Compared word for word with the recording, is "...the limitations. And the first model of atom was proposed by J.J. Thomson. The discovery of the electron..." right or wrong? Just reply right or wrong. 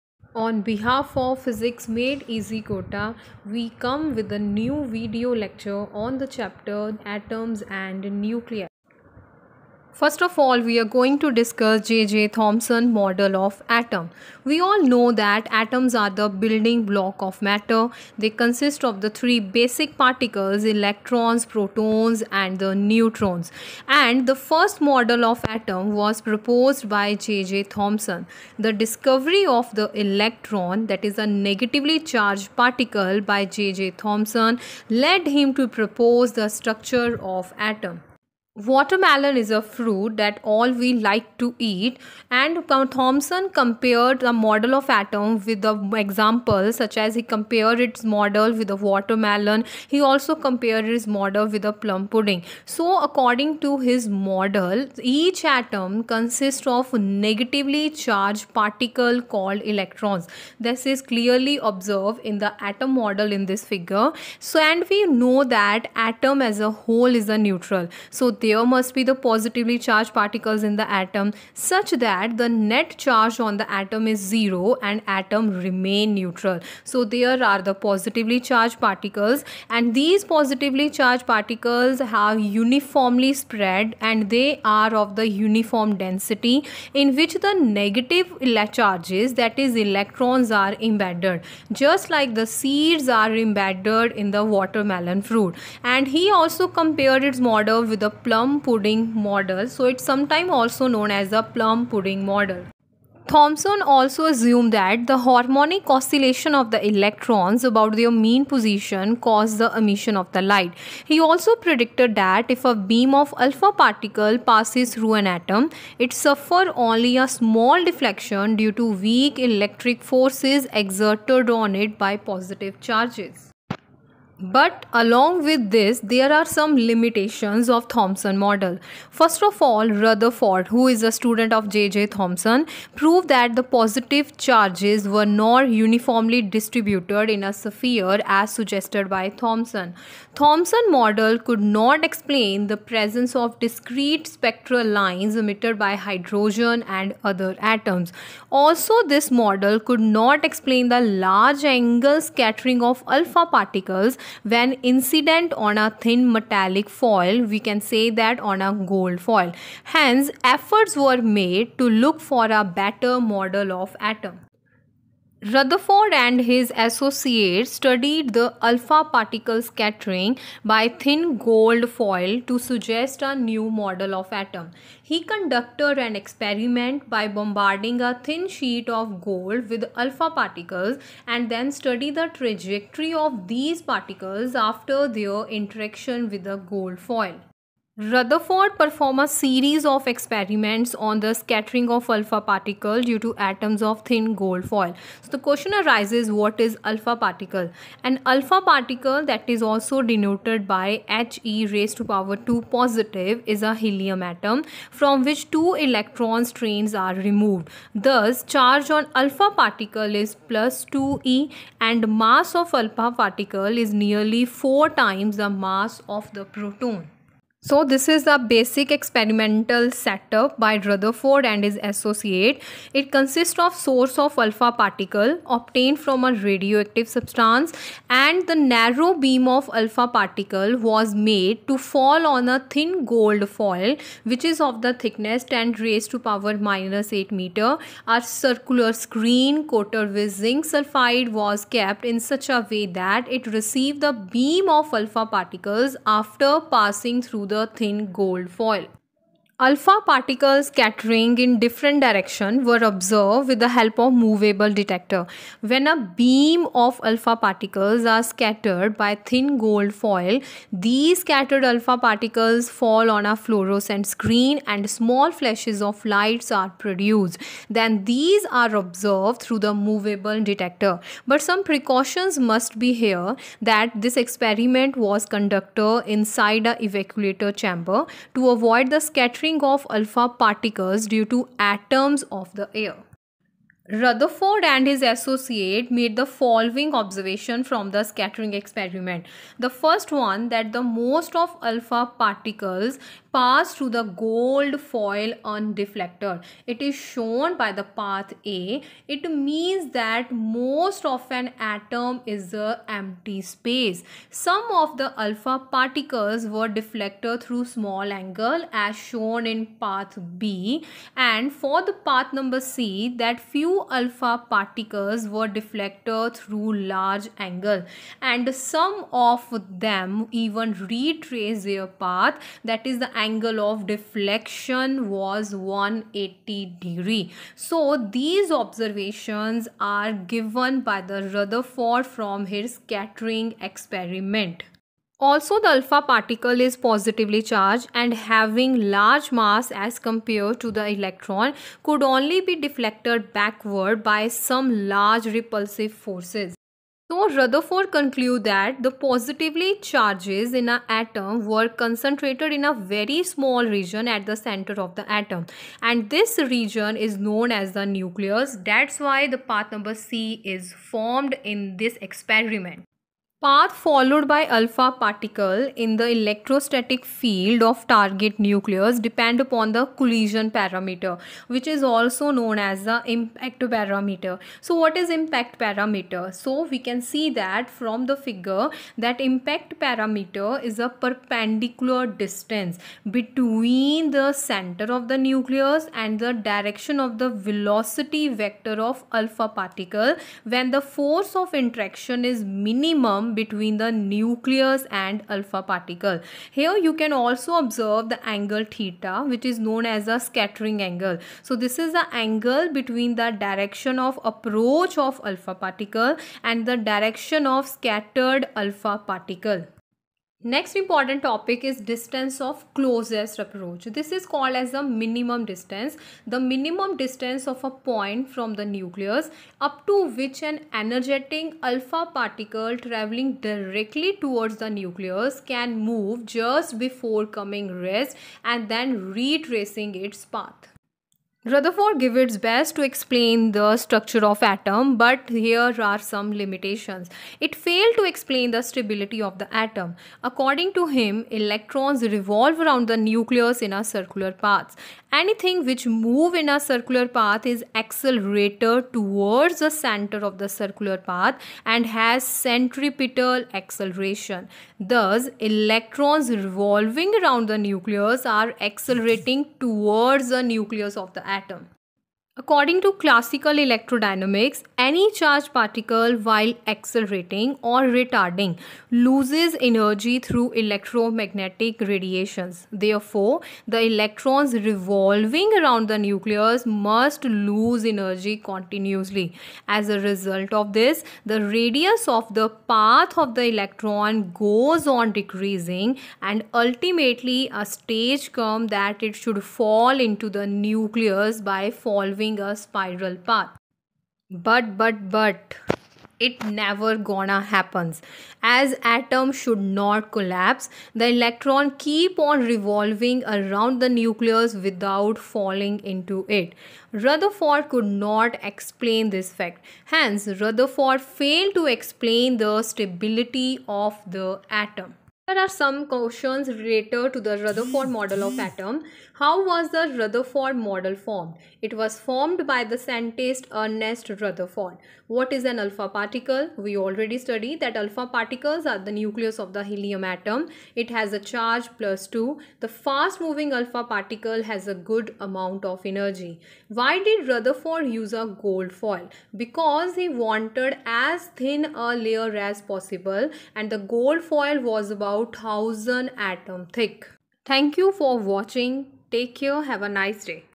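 wrong.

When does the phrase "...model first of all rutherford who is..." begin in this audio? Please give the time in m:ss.
2:08.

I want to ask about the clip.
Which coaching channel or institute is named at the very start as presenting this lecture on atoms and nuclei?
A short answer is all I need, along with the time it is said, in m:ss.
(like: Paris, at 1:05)
Physics Made Easy Kota, at 0:01.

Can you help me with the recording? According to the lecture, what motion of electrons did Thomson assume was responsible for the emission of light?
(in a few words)
Harmonic oscillation.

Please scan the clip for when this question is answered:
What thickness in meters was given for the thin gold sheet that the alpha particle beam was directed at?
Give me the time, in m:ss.
3:55.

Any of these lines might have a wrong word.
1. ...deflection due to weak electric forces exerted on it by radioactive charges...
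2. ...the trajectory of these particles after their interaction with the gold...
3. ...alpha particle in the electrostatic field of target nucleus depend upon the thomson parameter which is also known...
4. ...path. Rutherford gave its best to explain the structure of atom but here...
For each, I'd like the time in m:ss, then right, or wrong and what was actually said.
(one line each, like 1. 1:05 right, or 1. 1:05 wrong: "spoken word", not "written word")
1. 1:57 wrong: "positive", not "radioactive"
2. 3:02 right
3. 6:04 wrong: "collision", not "thomson"
4. 7:10 right.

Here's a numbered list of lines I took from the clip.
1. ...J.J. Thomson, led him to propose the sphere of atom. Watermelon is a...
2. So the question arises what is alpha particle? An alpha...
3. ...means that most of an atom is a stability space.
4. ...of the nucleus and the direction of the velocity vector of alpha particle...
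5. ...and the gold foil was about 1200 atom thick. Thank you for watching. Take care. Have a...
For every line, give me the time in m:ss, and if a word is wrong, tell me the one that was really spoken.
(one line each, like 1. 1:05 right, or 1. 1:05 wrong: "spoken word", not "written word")
1. 0:33 wrong: "structure", not "sphere"
2. 3:15 right
3. 4:59 wrong: "empty", not "stability"
4. 6:24 right
5. 9:03 wrong: "1000", not "1200".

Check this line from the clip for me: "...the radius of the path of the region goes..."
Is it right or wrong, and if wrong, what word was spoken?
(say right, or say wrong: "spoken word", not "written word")
wrong: "electron", not "region".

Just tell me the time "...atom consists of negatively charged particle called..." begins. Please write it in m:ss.
0:55.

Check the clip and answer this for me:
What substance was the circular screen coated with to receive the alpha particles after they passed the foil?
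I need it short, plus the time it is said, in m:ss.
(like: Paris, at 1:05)
Zinc sulfide, at 4:00.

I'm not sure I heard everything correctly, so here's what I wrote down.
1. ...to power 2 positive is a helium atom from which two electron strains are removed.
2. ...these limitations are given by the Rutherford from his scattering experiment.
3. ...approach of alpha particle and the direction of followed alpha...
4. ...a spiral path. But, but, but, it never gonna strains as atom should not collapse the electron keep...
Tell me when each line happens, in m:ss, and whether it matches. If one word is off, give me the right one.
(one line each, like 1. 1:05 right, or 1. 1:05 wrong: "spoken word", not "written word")
1. 3:21 right
2. 5:28 wrong: "observations", not "limitations"
3. 6:44 wrong: "scattered", not "followed"
4. 8:12 wrong: "happens", not "strains".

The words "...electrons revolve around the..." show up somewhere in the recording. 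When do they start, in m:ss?
7:21.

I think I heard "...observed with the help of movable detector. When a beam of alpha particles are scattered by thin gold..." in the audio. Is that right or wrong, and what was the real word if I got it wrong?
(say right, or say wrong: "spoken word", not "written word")
right.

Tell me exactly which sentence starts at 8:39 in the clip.
How was the Rutherford model formed?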